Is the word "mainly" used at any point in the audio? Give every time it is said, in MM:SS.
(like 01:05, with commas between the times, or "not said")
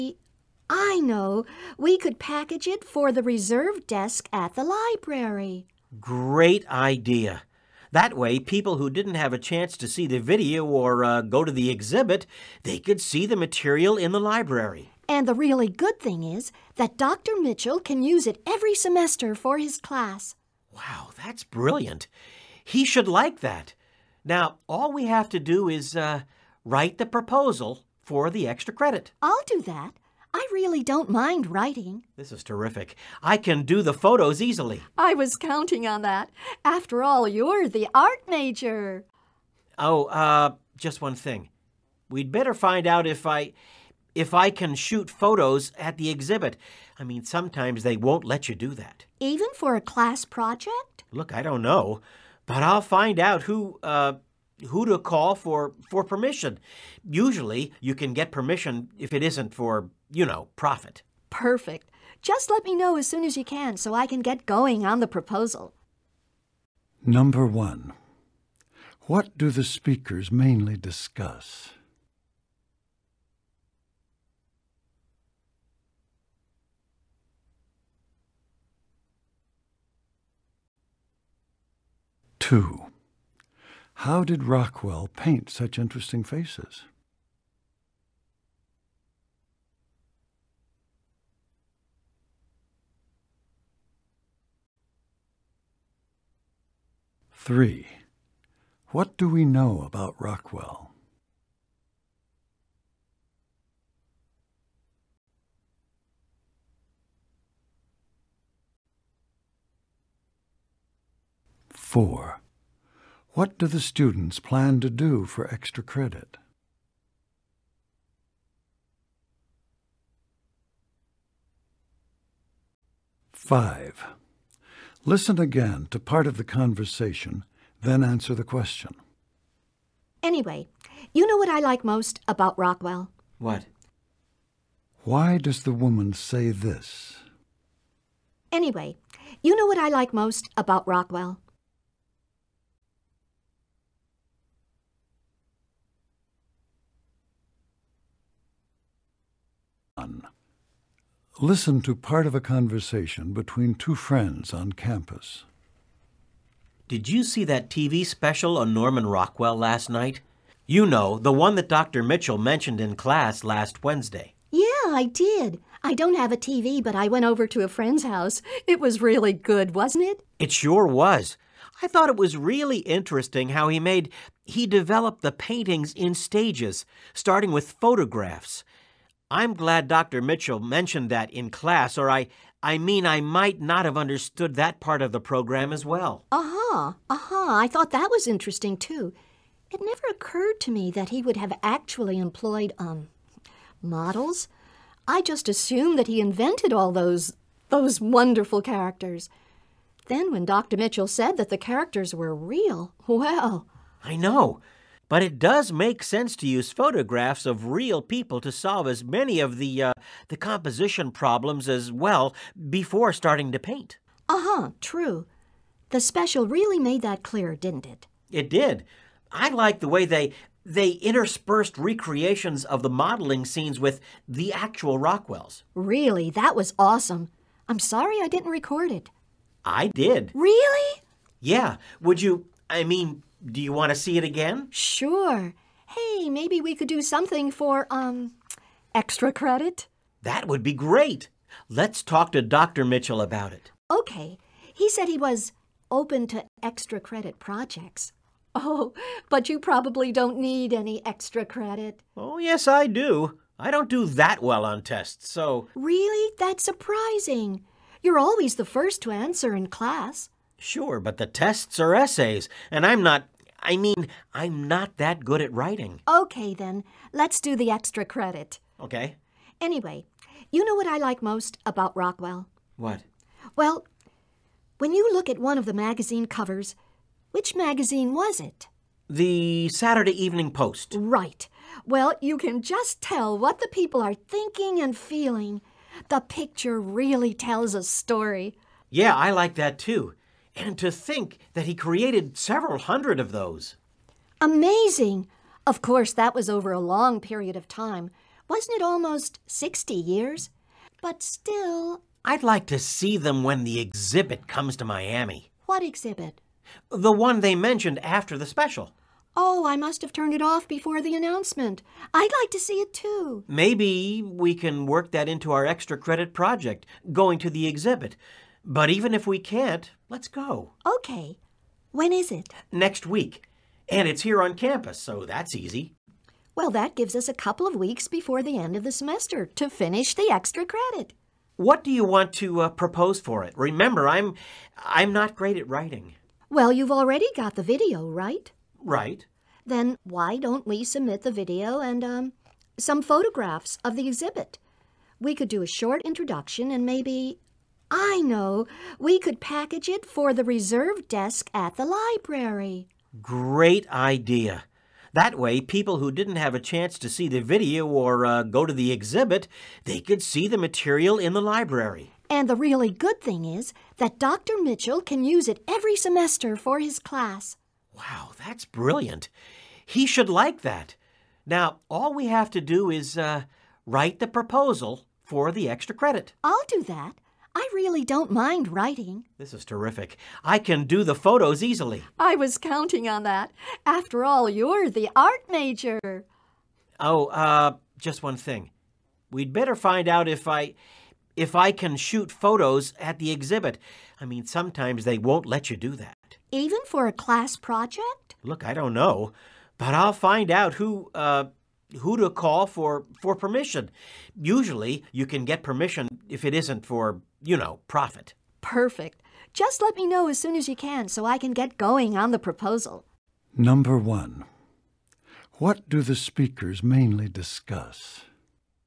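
01:10, 06:56.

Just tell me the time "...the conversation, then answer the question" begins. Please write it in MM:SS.
02:06.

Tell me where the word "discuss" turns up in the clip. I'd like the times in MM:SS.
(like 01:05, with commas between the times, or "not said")
01:10, 06:57.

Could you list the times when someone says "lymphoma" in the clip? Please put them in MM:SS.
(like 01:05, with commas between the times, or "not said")
not said.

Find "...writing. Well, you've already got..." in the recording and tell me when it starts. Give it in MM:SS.
05:35.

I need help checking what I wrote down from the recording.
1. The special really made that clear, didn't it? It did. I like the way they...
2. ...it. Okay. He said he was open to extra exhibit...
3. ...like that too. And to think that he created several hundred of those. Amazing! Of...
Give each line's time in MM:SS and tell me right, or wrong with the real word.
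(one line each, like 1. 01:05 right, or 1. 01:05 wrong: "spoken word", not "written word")
1. 03:35 right
2. 04:03 wrong: "credit", not "exhibit"
3. 04:49 right.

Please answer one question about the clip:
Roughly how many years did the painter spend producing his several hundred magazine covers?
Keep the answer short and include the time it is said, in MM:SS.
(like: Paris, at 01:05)
60, at 04:58.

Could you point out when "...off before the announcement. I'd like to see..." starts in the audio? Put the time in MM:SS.
05:10.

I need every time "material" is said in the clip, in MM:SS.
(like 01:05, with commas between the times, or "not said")
00:13, 06:00.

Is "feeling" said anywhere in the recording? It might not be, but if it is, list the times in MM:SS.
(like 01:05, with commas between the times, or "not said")
04:44.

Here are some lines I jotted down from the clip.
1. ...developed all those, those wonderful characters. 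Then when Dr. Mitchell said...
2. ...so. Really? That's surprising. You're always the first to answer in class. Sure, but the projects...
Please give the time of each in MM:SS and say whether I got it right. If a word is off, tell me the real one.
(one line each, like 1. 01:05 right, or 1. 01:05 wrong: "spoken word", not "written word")
1. 03:16 wrong: "invented", not "developed"
2. 04:15 wrong: "tests", not "projects".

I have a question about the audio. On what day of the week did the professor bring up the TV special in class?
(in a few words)
Wednesday.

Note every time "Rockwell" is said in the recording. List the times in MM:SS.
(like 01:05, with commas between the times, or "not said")
01:24, 01:40, 02:12, 02:20, 02:39, 03:44, 04:31.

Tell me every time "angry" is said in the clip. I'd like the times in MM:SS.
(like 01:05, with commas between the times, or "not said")
not said.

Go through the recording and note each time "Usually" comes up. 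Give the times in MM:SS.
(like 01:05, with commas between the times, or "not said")
00:57, 06:44.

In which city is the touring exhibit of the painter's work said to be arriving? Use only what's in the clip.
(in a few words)
Miami.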